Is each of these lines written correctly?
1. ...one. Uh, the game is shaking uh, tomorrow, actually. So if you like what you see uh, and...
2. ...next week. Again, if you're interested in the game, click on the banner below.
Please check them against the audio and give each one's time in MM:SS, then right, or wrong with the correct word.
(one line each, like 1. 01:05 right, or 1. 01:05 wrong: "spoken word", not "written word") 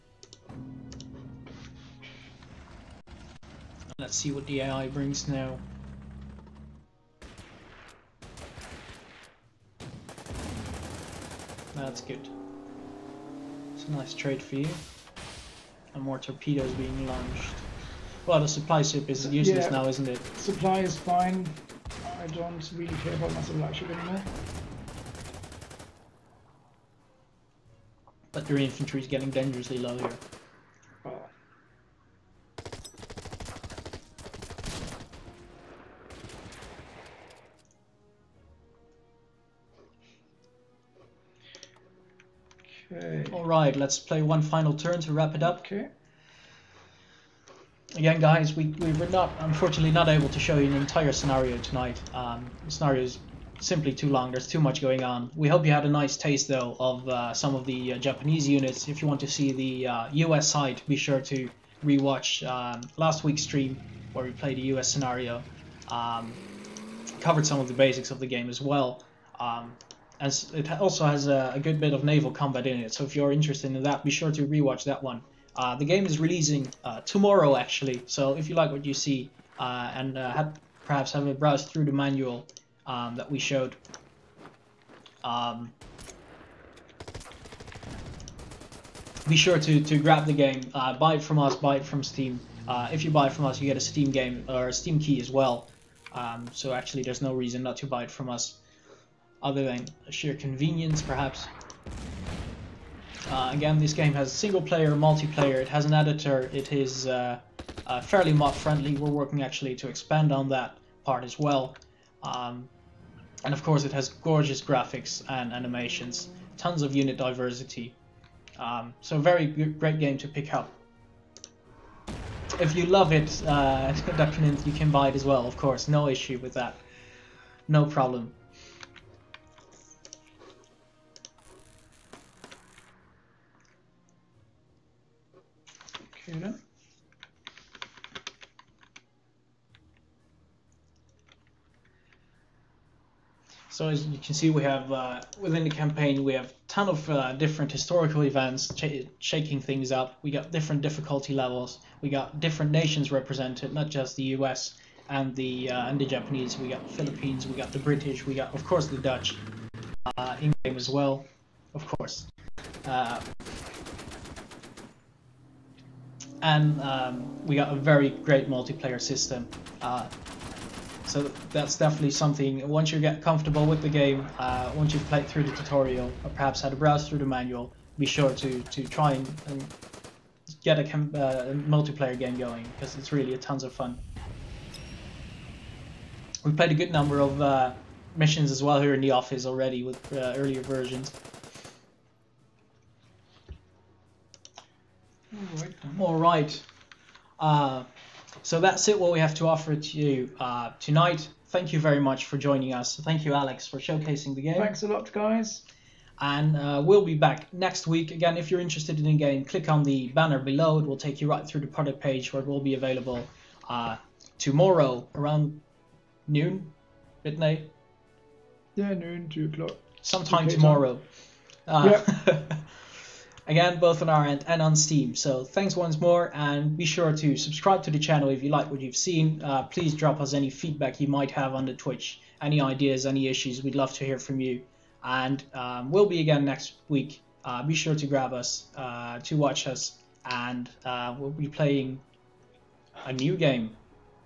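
1. 01:15 wrong: "releasing", not "shaking"
2. 03:27 right.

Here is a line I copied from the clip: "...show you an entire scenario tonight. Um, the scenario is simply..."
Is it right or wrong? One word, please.
right.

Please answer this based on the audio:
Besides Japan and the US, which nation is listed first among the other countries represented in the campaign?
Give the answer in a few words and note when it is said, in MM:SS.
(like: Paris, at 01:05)
The Philippines, at 02:36.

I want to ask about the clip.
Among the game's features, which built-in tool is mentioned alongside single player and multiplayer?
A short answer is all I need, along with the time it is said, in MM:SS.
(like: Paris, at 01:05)
An editor, at 01:45.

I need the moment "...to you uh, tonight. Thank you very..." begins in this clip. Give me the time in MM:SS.
03:19.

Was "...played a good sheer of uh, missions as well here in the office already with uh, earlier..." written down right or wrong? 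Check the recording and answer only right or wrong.
wrong.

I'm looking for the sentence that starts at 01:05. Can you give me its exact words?
Um, covered some of the basics of the game as well.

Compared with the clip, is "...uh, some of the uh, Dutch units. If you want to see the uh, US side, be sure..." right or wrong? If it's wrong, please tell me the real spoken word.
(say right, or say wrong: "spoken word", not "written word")
wrong: "Japanese", not "Dutch".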